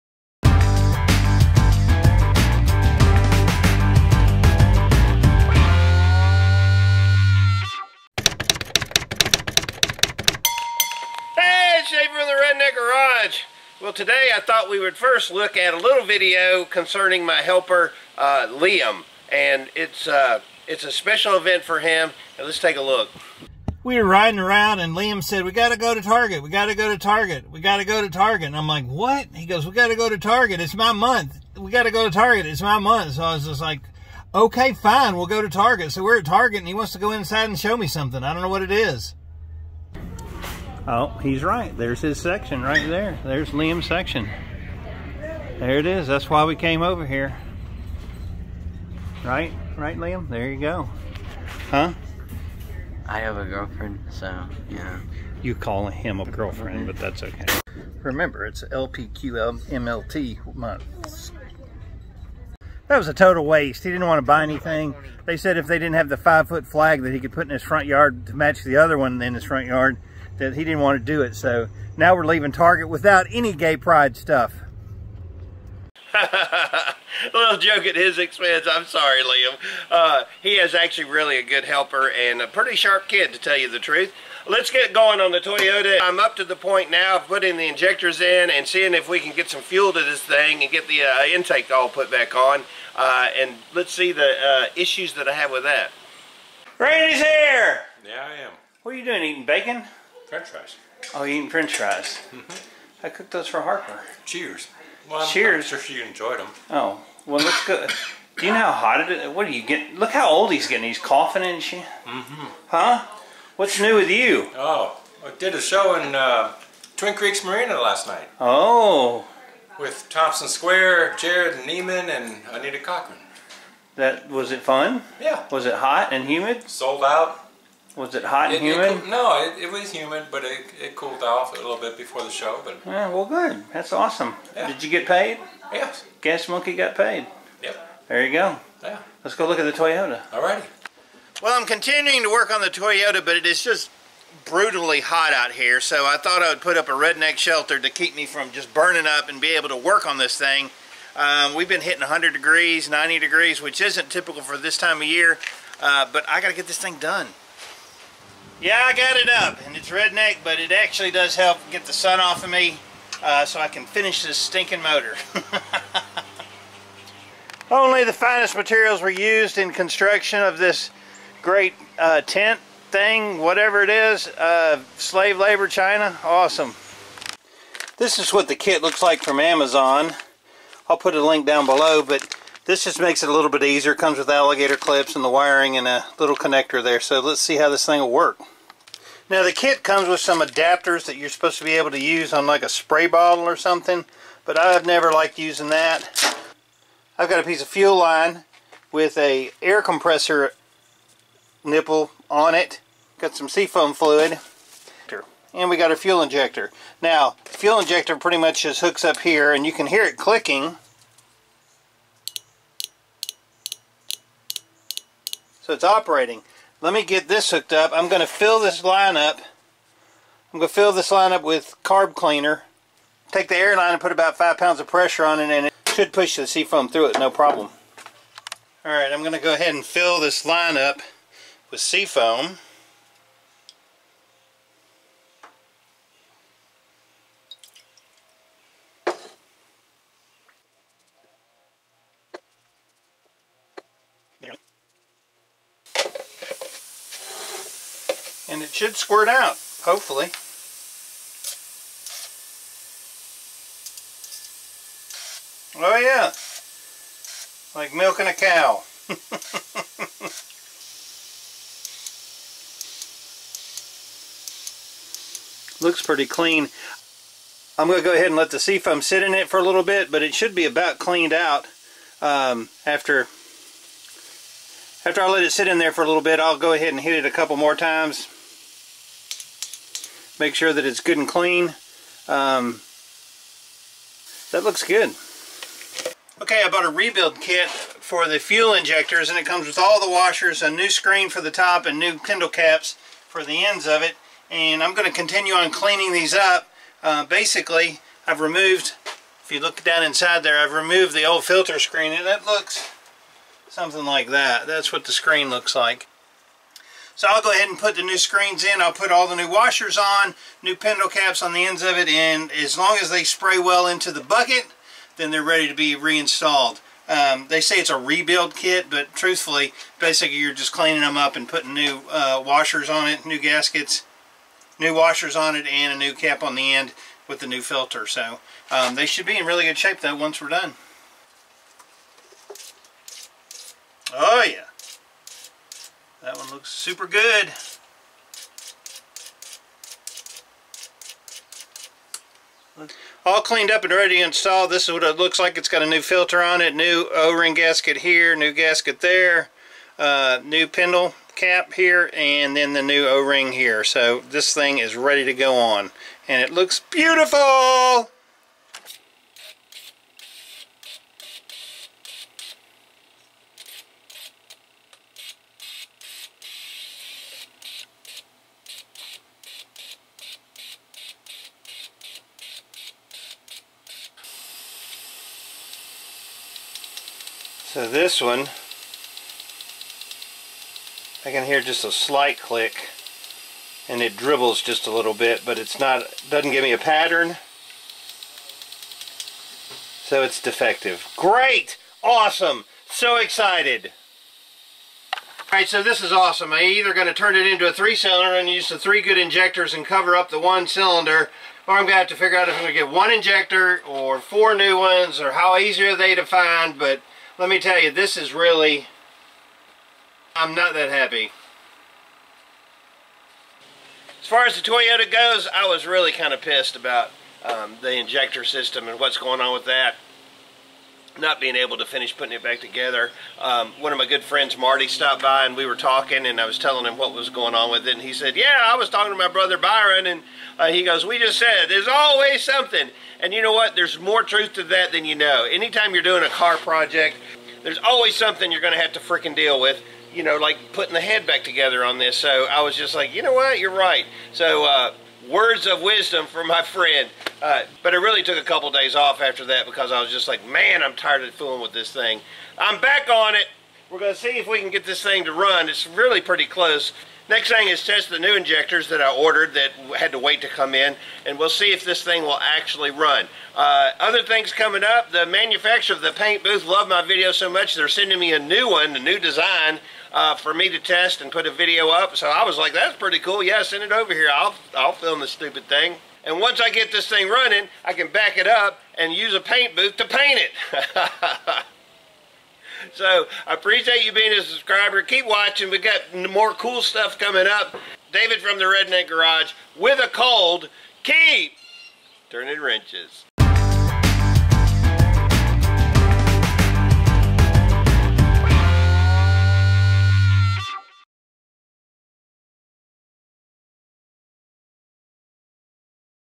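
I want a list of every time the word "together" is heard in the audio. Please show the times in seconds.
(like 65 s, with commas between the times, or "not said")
422 s, 441 s.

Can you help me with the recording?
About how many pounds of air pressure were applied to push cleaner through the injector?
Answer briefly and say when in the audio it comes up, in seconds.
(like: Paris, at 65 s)
5, at 224 s.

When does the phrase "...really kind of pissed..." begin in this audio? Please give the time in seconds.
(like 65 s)
415 s.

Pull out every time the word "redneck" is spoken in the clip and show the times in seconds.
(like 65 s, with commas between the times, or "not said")
146 s, 159 s, 488 s.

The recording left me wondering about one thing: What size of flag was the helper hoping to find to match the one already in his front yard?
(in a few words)
five-foot.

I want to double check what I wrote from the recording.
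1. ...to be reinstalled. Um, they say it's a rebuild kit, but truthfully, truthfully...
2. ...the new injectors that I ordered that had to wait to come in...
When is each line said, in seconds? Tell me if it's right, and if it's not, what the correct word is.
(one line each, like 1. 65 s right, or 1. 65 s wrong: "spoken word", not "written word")
1. 315 s wrong: "basically", not "truthfully"
2. 458 s right.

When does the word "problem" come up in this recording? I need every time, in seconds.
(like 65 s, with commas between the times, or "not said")
227 s.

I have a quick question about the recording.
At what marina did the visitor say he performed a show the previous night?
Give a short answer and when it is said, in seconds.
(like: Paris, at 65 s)
Twin Creeks Marina, at 116 s.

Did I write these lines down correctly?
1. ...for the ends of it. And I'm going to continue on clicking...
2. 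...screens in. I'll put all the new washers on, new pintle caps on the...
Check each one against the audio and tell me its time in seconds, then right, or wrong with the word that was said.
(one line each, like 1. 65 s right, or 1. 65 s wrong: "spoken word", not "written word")
1. 293 s wrong: "cleaning", not "clicking"
2. 308 s right.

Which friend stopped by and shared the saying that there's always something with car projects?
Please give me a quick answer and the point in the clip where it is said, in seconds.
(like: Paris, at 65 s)
Marty, at 424 s.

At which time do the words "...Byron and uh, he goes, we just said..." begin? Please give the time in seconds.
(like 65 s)
429 s.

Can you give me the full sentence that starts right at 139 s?
Let's go look at the Toyota.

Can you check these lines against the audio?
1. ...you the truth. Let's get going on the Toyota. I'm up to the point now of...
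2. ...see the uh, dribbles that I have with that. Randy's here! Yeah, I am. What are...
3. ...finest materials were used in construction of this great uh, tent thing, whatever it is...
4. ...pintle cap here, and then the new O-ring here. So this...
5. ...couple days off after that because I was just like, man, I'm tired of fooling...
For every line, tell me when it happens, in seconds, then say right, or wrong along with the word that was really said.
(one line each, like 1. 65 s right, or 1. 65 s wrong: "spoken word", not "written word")
1. 83 s right
2. 93 s wrong: "issues", not "dribbles"
3. 168 s right
4. 350 s right
5. 448 s right.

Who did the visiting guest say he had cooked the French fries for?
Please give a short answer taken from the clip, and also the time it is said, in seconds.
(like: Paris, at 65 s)
Harper, at 103 s.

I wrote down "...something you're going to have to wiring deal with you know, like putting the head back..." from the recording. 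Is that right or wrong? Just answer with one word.
wrong.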